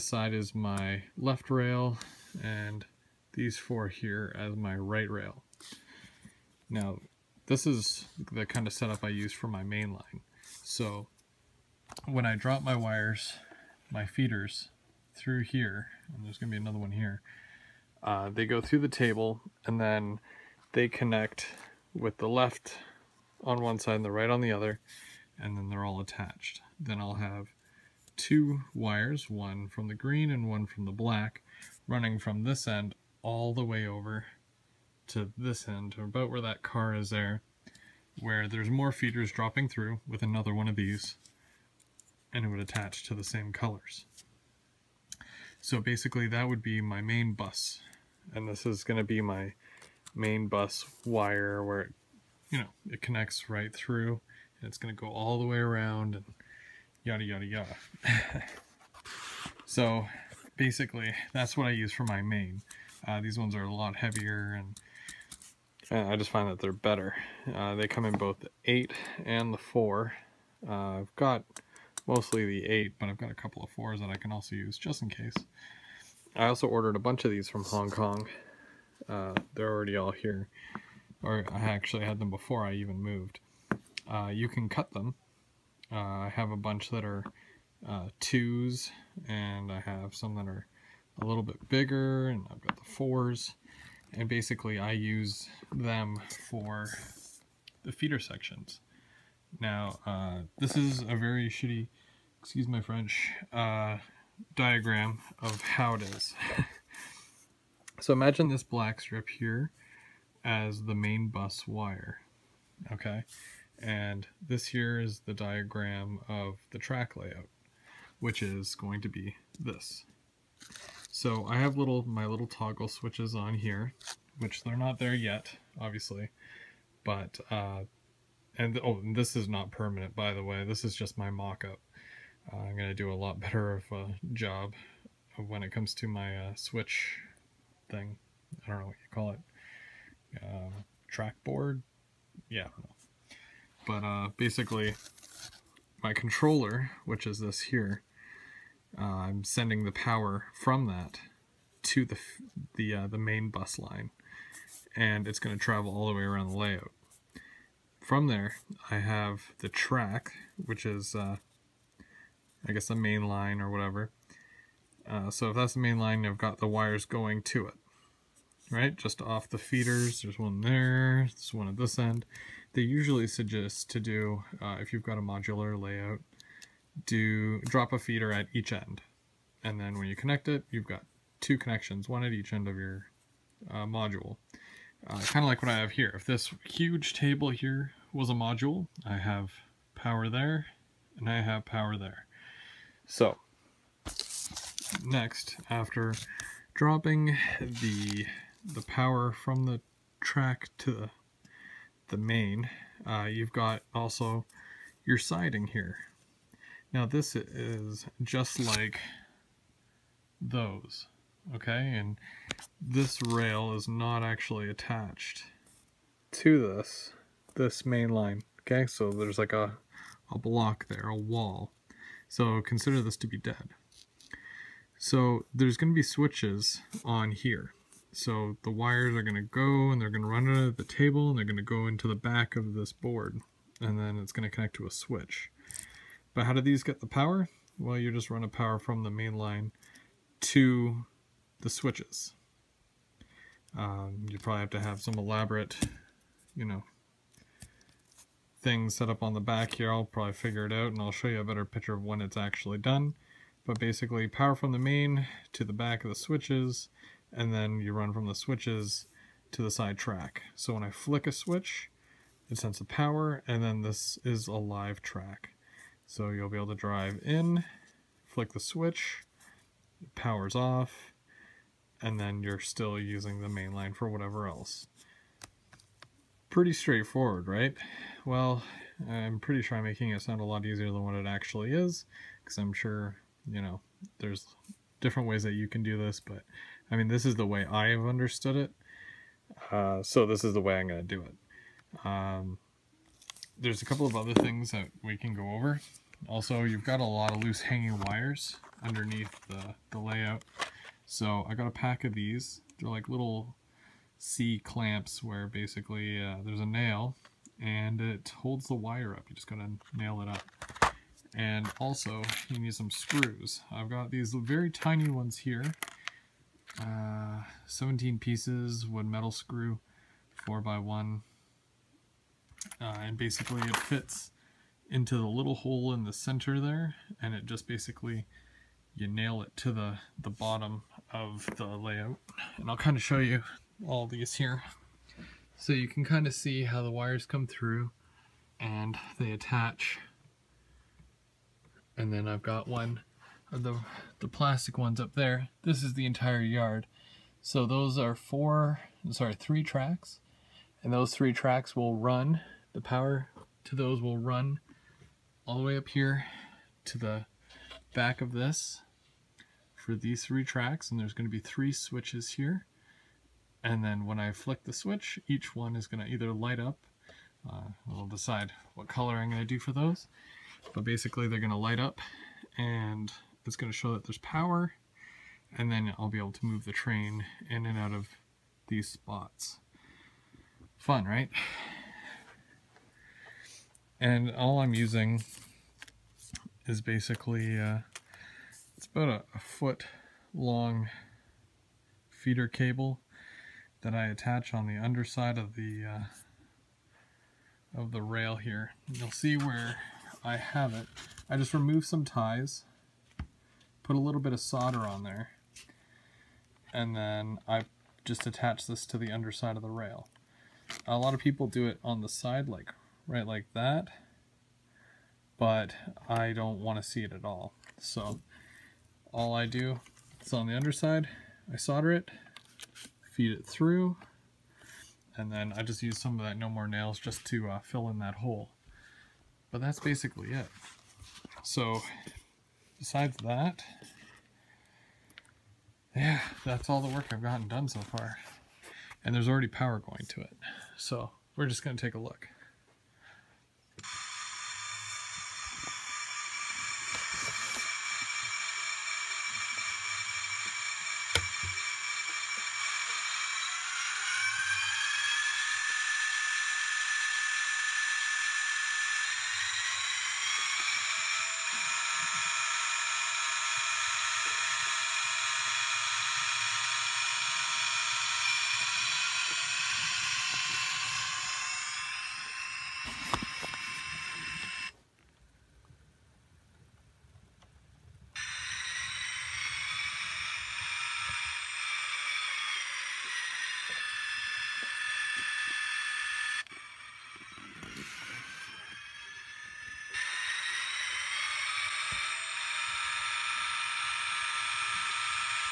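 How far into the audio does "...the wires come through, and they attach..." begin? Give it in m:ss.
5:36.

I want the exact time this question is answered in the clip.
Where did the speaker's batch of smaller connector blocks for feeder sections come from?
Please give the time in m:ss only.
1:17.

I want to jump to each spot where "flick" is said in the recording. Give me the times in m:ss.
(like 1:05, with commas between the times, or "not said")
4:20, 4:28, 6:04.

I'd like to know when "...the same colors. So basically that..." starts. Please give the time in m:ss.
0:43.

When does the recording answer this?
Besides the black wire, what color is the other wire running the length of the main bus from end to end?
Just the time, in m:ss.
0:29.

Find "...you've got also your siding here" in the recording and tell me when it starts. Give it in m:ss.
3:23.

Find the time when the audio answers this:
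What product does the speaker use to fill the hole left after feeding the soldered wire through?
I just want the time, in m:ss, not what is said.
7:06.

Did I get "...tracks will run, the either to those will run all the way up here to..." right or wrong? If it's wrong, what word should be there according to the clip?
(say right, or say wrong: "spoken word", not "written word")
wrong: "power", not "either".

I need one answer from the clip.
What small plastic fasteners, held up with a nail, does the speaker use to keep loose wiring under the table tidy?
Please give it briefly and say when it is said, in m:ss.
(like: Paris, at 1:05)
C clamps, at 5:04.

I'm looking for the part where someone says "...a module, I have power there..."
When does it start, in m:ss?
3:08.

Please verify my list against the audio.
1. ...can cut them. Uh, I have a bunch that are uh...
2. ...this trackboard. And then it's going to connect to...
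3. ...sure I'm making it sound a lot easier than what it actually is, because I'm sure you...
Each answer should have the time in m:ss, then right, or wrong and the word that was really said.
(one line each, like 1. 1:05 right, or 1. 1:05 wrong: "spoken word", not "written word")
1. 1:24 right
2. 3:52 wrong: "board", not "trackboard"
3. 4:39 right.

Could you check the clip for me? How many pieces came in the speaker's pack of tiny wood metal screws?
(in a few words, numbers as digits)
17.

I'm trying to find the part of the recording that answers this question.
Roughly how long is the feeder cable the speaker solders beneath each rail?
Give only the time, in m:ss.
6:29.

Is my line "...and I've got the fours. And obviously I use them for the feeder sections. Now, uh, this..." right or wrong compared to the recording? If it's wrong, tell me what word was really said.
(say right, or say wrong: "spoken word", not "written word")
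wrong: "basically", not "obviously".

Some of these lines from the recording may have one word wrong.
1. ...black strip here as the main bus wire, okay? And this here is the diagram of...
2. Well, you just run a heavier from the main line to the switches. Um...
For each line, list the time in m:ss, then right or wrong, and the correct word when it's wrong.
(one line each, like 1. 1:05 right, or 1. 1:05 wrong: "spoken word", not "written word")
1. 1:48 right
2. 3:57 wrong: "power", not "heavier".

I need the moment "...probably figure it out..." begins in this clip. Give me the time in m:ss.
4:10.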